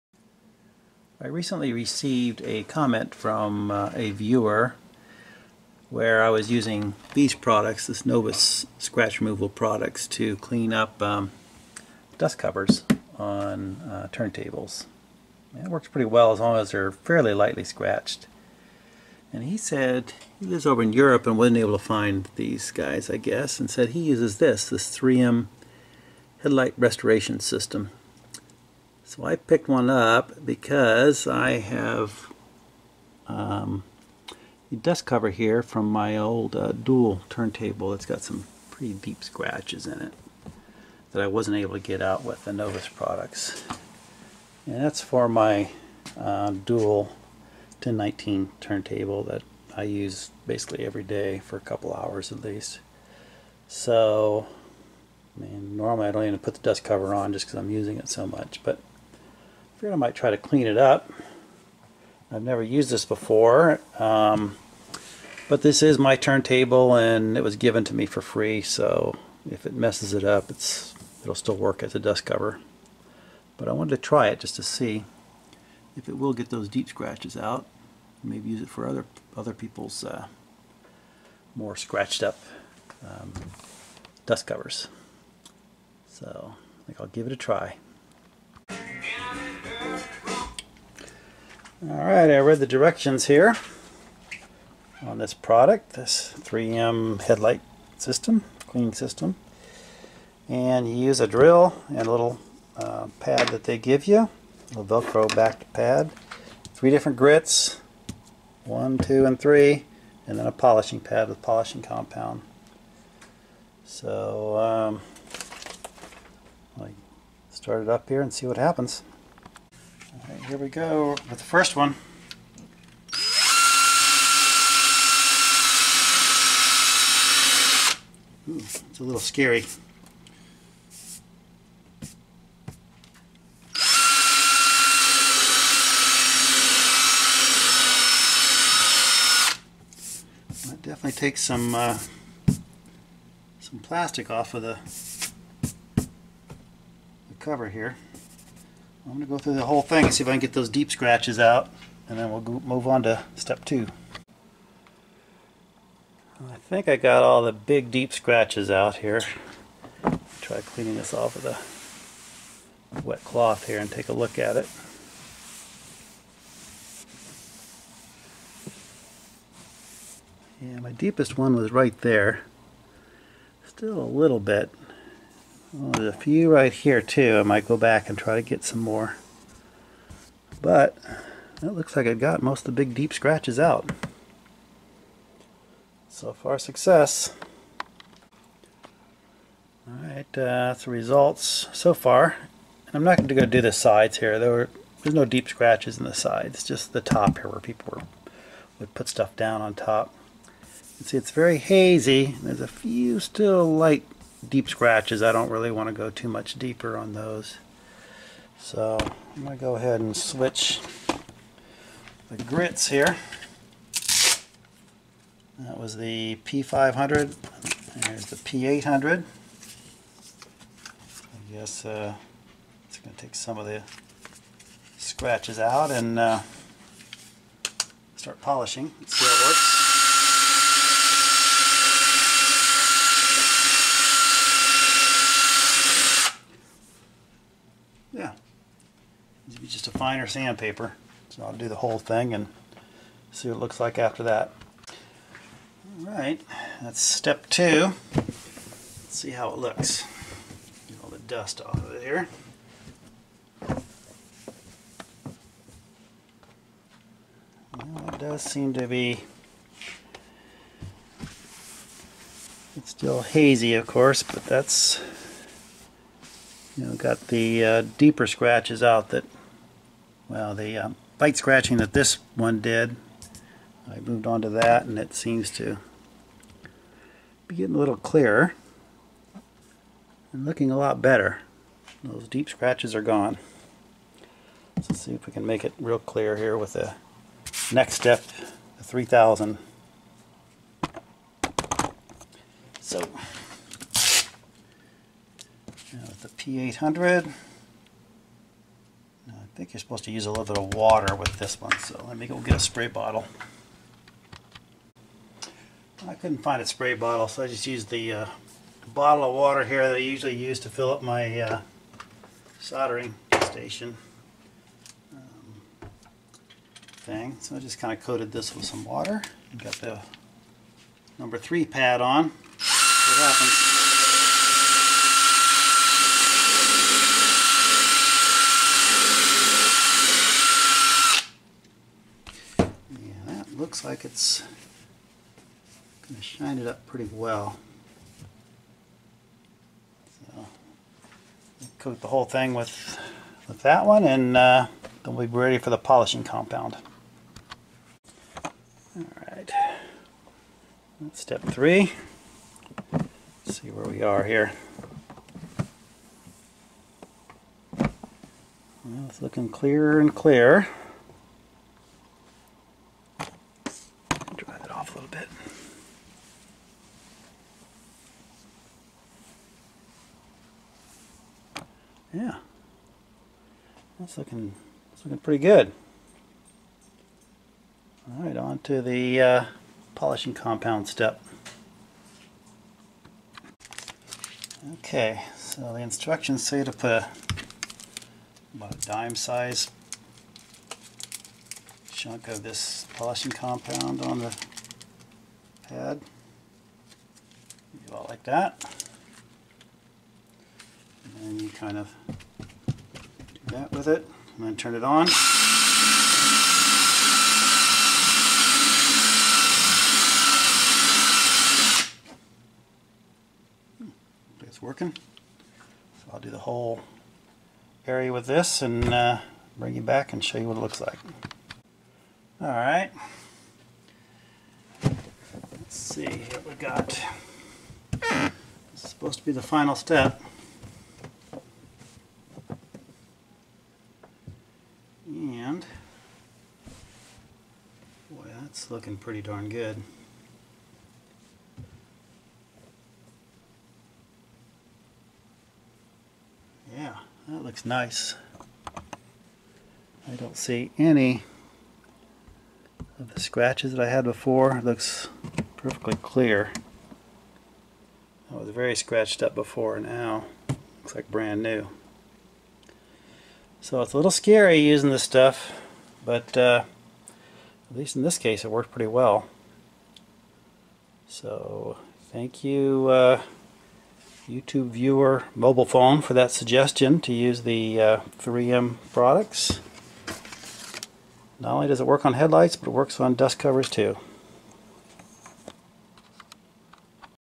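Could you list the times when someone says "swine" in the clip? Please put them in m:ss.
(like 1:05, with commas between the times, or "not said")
not said.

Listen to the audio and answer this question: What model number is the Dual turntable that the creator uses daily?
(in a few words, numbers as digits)
1019.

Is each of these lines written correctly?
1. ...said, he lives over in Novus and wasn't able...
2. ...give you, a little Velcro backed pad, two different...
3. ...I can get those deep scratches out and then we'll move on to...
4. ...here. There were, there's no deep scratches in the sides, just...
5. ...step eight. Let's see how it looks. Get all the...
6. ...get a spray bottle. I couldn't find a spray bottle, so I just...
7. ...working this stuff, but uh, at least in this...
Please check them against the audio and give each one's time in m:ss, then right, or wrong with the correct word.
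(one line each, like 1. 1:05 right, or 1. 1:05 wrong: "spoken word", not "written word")
1. 0:19 wrong: "Europe", not "Novus"
2. 1:43 wrong: "three", not "two"
3. 2:30 right
4. 3:14 right
5. 4:06 wrong: "two", not "eight"
6. 5:02 right
7. 7:44 wrong: "using", not "working".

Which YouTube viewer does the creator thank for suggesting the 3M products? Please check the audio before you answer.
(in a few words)
mobile phone.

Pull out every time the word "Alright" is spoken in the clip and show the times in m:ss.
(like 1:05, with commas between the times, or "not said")
1:31, 3:09, 5:48.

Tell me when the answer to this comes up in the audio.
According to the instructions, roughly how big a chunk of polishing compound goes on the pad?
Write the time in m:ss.
6:28.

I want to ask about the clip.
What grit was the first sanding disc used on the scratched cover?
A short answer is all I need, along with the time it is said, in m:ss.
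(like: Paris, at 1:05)
P500, at 3:36.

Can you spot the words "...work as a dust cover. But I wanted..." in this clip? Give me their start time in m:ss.
1:11.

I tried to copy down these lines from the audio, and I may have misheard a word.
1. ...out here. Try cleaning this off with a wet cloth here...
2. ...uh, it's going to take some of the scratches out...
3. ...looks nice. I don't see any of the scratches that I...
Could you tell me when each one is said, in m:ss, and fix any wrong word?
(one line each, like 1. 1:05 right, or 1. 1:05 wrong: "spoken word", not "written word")
1. 2:38 right
2. 3:41 right
3. 7:27 right.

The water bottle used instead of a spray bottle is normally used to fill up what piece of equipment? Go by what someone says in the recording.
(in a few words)
soldering station.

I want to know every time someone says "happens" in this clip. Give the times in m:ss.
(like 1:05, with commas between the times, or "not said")
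1:58, 5:23.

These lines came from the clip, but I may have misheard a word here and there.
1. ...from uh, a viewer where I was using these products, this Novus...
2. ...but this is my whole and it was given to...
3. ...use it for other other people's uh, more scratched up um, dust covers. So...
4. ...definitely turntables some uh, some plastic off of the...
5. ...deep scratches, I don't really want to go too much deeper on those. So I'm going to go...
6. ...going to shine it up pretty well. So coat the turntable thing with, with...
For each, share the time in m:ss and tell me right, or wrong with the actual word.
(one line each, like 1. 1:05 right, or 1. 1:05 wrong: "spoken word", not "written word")
1. 0:03 right
2. 1:05 wrong: "turntable", not "whole"
3. 1:18 right
4. 2:20 wrong: "takes", not "turntables"
5. 3:24 right
6. 5:36 wrong: "whole", not "turntable".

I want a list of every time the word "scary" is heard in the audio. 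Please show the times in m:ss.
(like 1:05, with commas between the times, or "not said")
2:09, 7:44.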